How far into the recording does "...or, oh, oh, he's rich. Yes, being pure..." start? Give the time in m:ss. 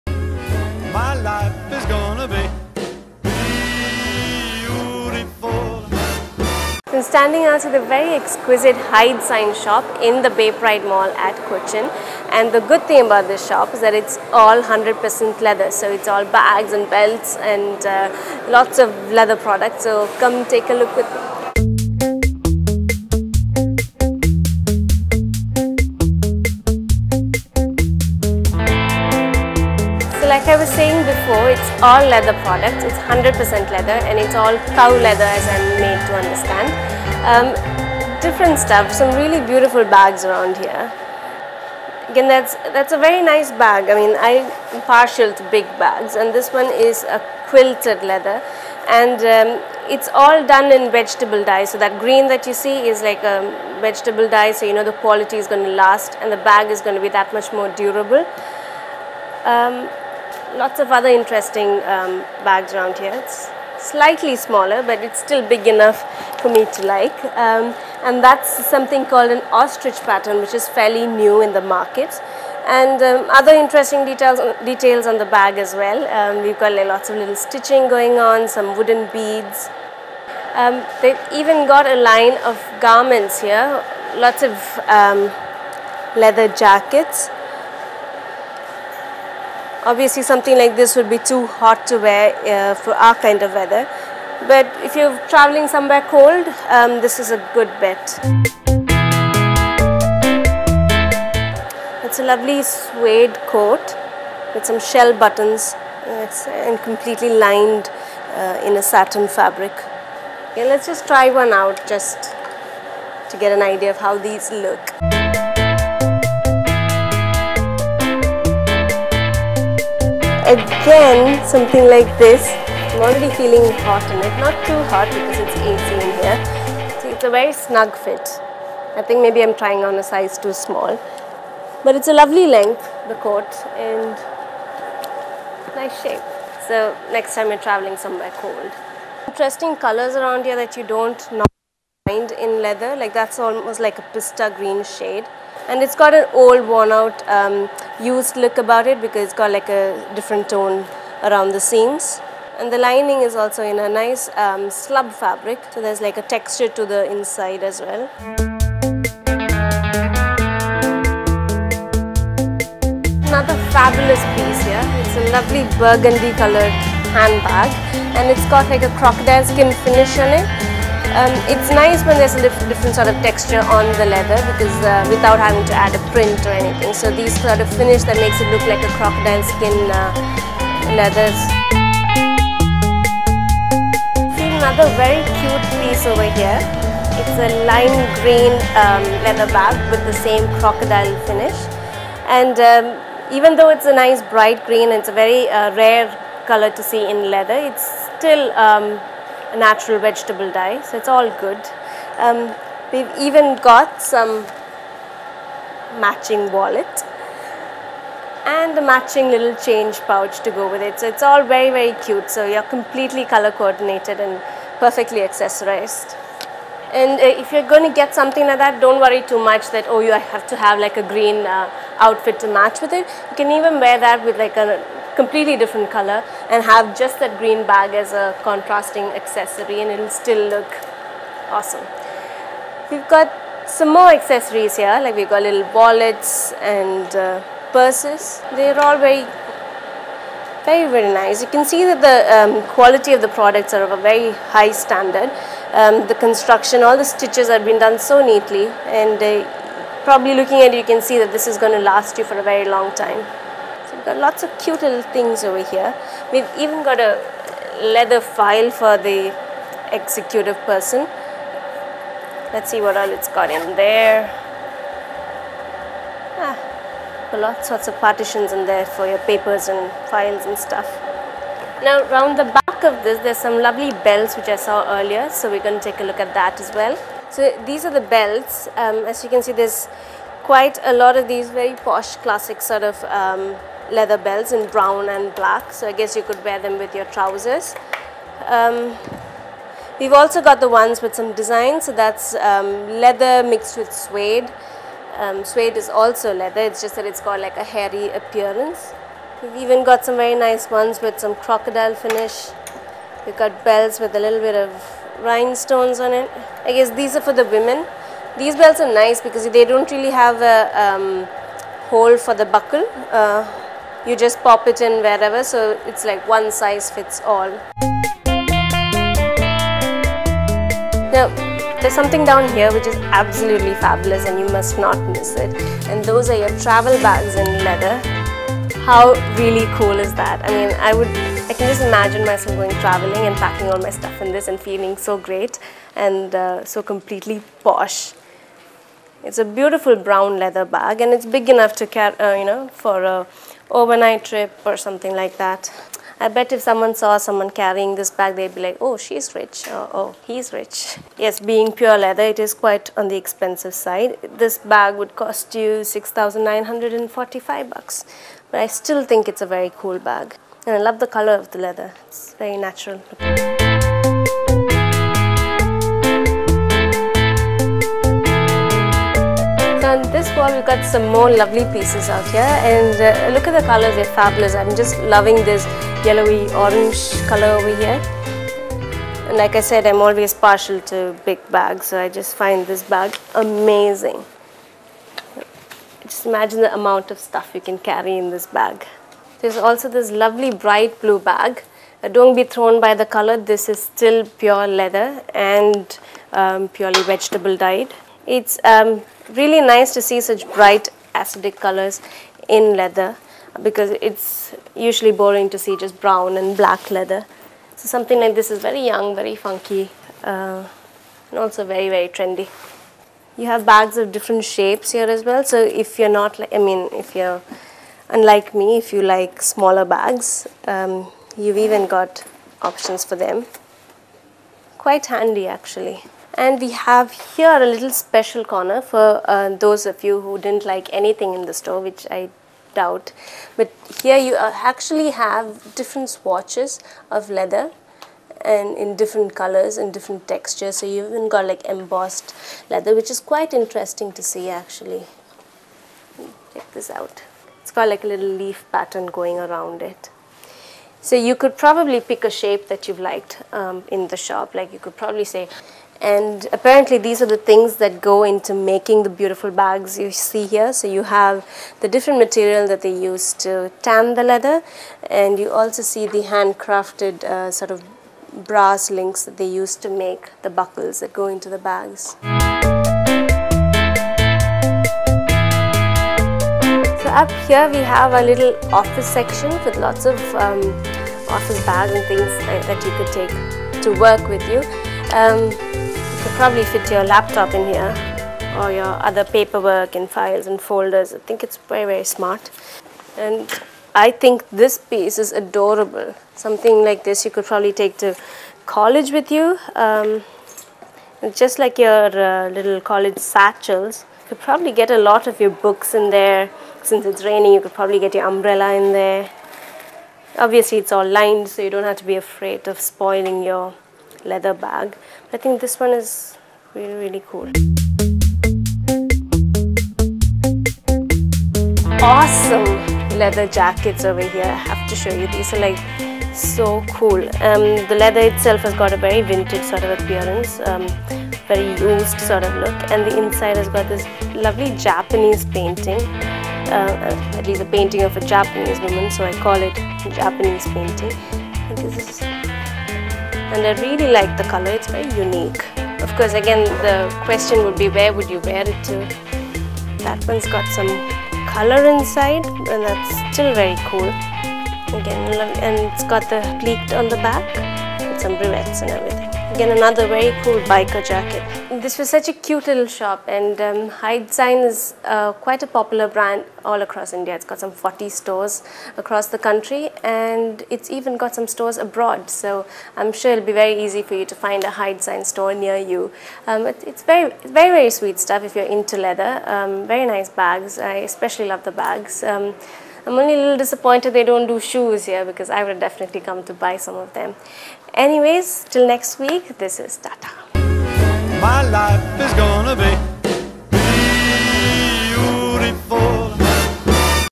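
5:49.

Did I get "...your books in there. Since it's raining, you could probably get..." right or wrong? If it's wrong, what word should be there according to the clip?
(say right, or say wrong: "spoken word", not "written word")
right.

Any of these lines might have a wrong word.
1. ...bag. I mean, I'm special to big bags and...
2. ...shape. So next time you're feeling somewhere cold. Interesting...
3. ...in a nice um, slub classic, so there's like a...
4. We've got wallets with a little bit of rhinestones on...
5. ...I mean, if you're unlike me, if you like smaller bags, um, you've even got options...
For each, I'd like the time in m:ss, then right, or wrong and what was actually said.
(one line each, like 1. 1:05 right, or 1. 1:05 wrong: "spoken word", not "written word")
1. 0:43 wrong: "partial", not "special"
2. 2:16 wrong: "traveling", not "feeling"
3. 2:33 wrong: "fabric", not "classic"
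4. 5:03 wrong: "belts", not "wallets"
5. 6:56 right.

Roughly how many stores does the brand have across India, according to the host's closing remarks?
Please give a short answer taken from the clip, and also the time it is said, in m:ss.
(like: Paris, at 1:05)
40, at 9:27.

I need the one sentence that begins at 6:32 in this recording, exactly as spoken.
Uh, don't be thrown by the color, this is still pure leather and um, purely vegetable dyed.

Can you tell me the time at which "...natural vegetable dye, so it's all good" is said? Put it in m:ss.
3:19.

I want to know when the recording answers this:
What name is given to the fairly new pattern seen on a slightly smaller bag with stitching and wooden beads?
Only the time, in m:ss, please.
1:09.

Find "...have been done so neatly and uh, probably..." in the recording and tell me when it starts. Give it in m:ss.
4:07.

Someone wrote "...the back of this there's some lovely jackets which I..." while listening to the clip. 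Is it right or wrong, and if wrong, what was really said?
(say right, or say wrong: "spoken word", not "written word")
wrong: "belts", not "jackets".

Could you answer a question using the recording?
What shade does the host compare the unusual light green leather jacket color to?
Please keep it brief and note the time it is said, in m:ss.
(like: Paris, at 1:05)
Pista green, at 2:24.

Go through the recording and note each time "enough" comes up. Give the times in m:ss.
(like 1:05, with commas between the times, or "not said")
1:05, 5:41.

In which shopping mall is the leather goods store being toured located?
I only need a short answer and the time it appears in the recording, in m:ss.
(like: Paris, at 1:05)
Bay Pride Mall, at 0:10.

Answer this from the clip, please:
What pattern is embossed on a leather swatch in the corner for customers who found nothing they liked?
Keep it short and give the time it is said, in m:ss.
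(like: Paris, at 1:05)
Leaf pattern, at 7:28.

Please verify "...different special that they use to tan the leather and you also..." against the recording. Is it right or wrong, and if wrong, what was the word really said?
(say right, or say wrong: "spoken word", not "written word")
wrong: "material", not "special".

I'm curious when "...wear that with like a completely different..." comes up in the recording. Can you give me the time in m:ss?
3:43.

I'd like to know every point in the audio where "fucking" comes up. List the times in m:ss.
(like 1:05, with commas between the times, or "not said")
not said.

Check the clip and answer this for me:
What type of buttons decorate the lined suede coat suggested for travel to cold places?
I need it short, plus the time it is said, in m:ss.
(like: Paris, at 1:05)
Shell buttons, at 1:44.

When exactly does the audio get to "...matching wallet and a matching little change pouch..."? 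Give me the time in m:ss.
3:25.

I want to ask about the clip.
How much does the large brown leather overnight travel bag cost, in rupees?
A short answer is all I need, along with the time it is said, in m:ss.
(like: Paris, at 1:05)
6,945, at 5:55.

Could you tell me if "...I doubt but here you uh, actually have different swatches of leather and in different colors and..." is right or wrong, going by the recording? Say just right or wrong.
right.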